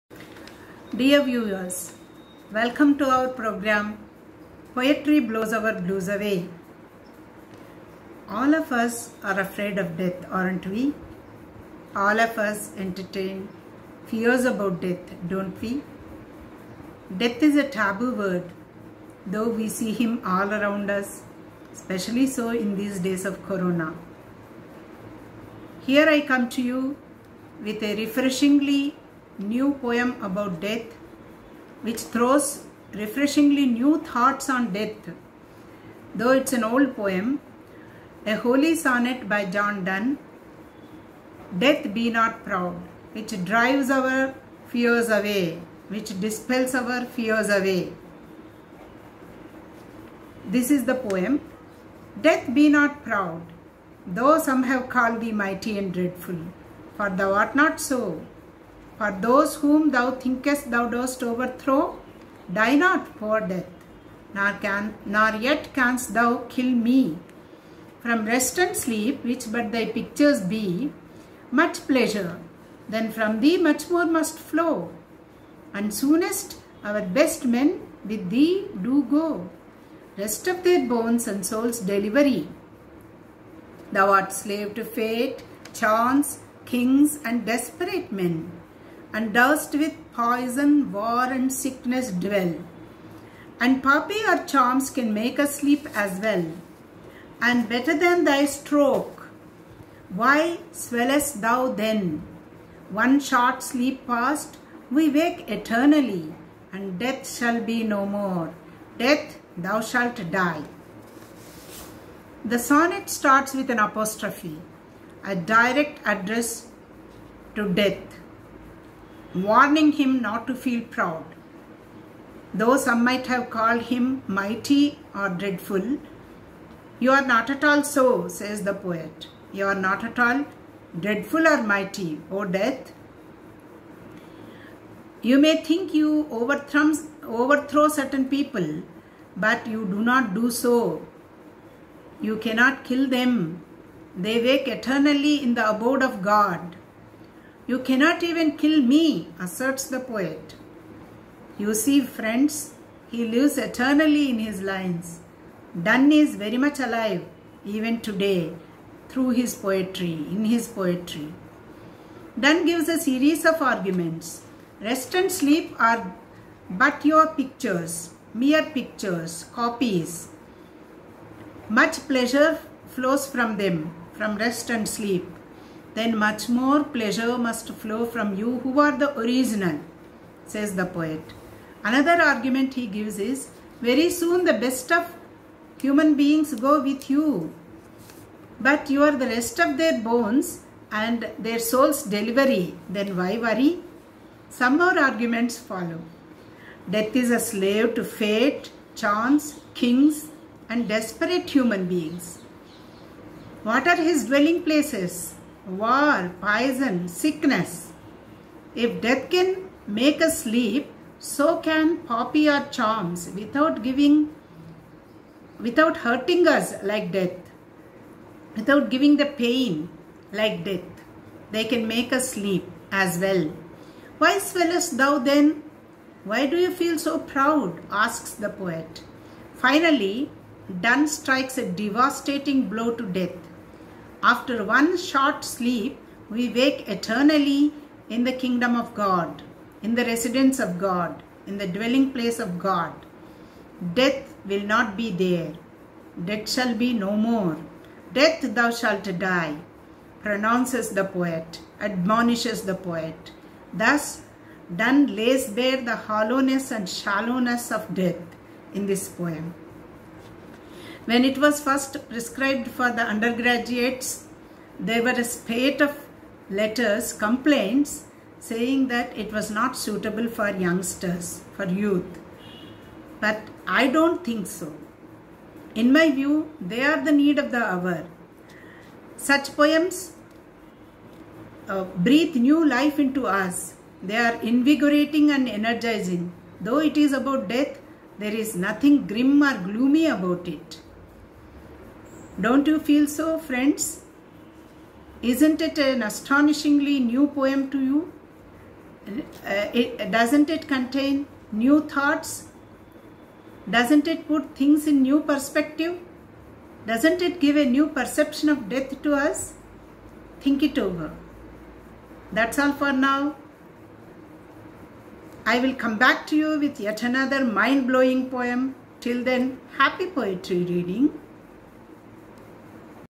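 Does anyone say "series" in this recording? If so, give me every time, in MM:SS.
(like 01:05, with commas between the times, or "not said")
02:42.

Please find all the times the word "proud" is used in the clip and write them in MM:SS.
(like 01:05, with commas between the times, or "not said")
00:42, 00:53, 02:00, 03:47.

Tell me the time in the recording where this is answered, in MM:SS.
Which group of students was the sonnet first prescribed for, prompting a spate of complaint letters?
04:23.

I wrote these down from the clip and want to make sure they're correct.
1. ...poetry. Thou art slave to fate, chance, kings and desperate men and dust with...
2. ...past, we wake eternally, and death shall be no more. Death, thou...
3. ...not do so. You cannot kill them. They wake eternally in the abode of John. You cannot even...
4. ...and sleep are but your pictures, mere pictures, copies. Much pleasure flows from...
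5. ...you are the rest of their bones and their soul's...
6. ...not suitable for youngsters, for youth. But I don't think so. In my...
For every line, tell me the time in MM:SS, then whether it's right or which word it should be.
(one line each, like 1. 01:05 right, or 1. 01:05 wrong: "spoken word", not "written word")
1. 01:21 wrong: "delivery", not "poetry"
2. 01:44 right
3. 02:20 wrong: "God", not "John"
4. 02:45 right
5. 03:08 right
6. 04:29 right.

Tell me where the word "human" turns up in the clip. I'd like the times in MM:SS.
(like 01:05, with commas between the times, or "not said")
03:05, 03:21.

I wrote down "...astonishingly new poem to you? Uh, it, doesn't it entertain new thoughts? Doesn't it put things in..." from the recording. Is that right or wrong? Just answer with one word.
wrong.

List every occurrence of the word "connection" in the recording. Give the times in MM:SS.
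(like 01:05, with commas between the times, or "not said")
not said.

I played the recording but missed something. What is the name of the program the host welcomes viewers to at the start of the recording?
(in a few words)
Poetry Blows Our Blues Away.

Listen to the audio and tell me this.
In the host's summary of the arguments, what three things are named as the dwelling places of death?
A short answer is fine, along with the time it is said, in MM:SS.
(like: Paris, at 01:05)
war, poison, sickness, at 03:25.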